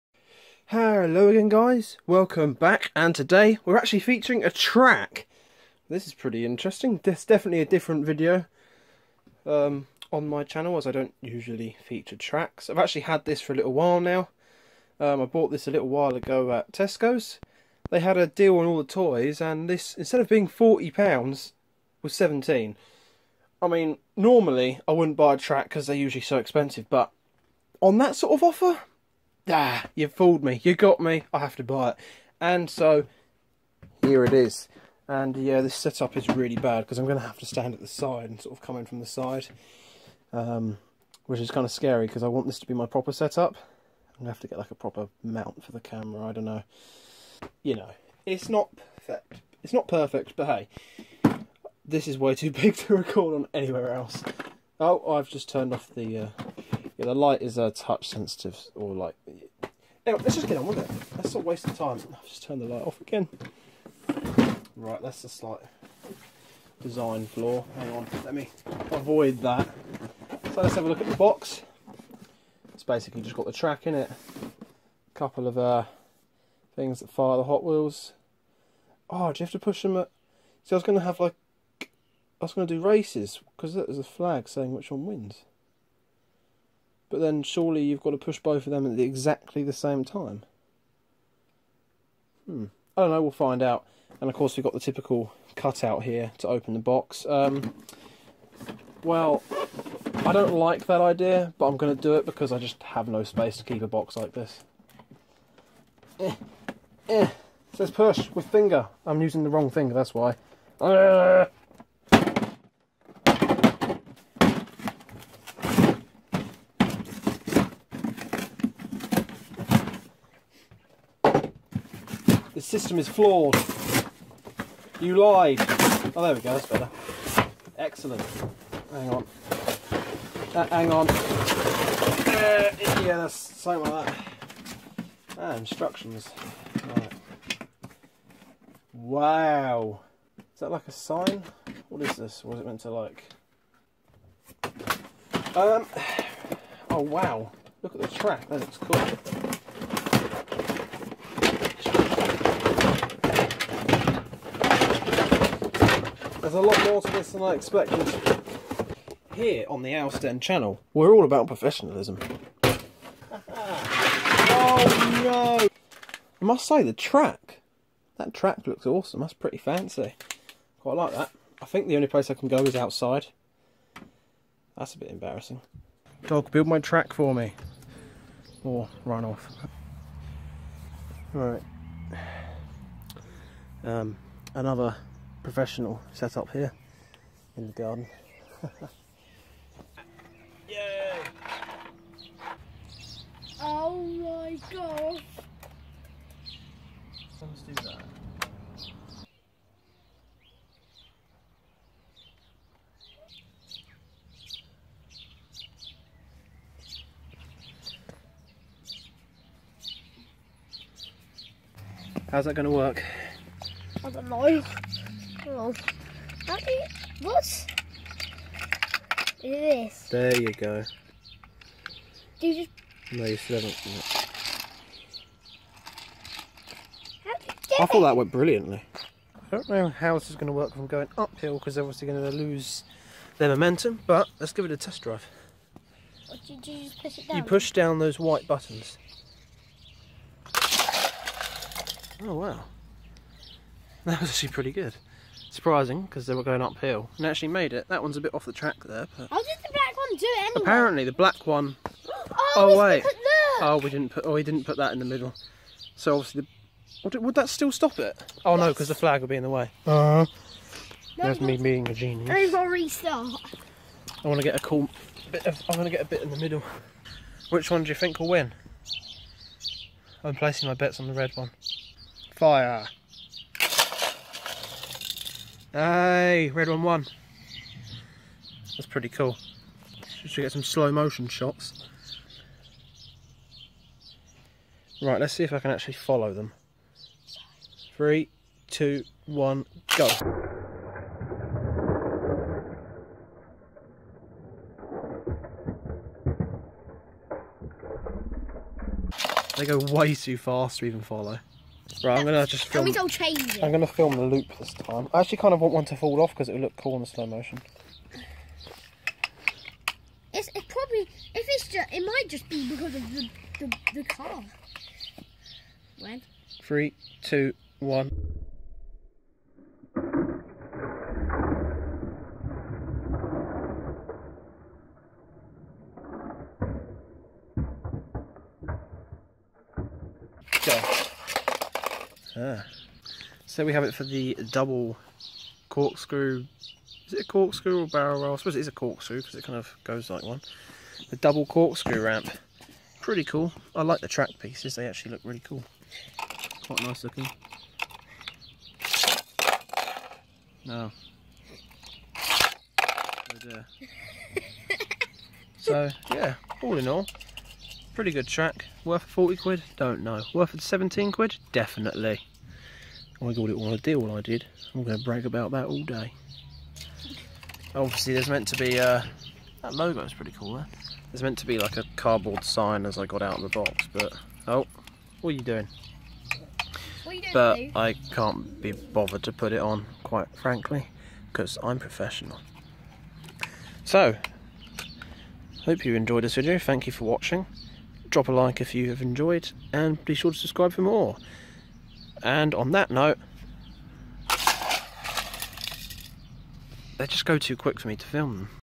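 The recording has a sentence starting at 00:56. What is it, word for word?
Uh, yeah, the light is uh, touch sensitive or like Anyway, let's just get on with it.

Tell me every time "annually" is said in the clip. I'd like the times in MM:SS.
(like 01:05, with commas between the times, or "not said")
not said.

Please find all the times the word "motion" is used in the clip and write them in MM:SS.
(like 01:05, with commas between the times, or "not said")
04:40, 05:07.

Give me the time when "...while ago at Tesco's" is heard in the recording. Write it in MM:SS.
00:15.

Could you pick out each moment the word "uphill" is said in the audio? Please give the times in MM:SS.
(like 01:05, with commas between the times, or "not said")
03:51, 04:06.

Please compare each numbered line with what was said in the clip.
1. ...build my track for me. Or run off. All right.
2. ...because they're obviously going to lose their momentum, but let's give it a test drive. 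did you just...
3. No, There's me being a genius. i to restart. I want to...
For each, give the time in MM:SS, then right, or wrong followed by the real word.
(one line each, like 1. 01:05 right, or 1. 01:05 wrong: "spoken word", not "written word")
1. 02:56 right
2. 03:51 right
3. 04:21 right.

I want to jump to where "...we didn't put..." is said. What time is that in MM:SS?
04:13.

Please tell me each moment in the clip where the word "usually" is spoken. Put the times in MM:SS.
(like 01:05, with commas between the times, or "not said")
00:11, 00:25.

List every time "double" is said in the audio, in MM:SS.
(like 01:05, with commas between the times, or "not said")
05:34, 05:41.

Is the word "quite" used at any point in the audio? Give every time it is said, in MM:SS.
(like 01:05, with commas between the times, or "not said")
02:50, 05:46, 06:20.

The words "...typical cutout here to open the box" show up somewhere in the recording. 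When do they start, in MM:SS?
01:34.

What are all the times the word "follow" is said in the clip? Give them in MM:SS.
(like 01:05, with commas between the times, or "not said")
04:45, 05:01.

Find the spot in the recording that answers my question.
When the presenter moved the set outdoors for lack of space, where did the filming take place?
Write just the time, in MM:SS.
03:07.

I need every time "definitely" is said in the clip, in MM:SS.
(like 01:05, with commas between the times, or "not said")
00:07, 06:01.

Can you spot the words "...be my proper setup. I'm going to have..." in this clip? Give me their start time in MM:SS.
00:42.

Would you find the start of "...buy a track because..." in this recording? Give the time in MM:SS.
00:25.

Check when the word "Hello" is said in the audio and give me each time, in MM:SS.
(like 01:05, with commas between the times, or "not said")
00:00.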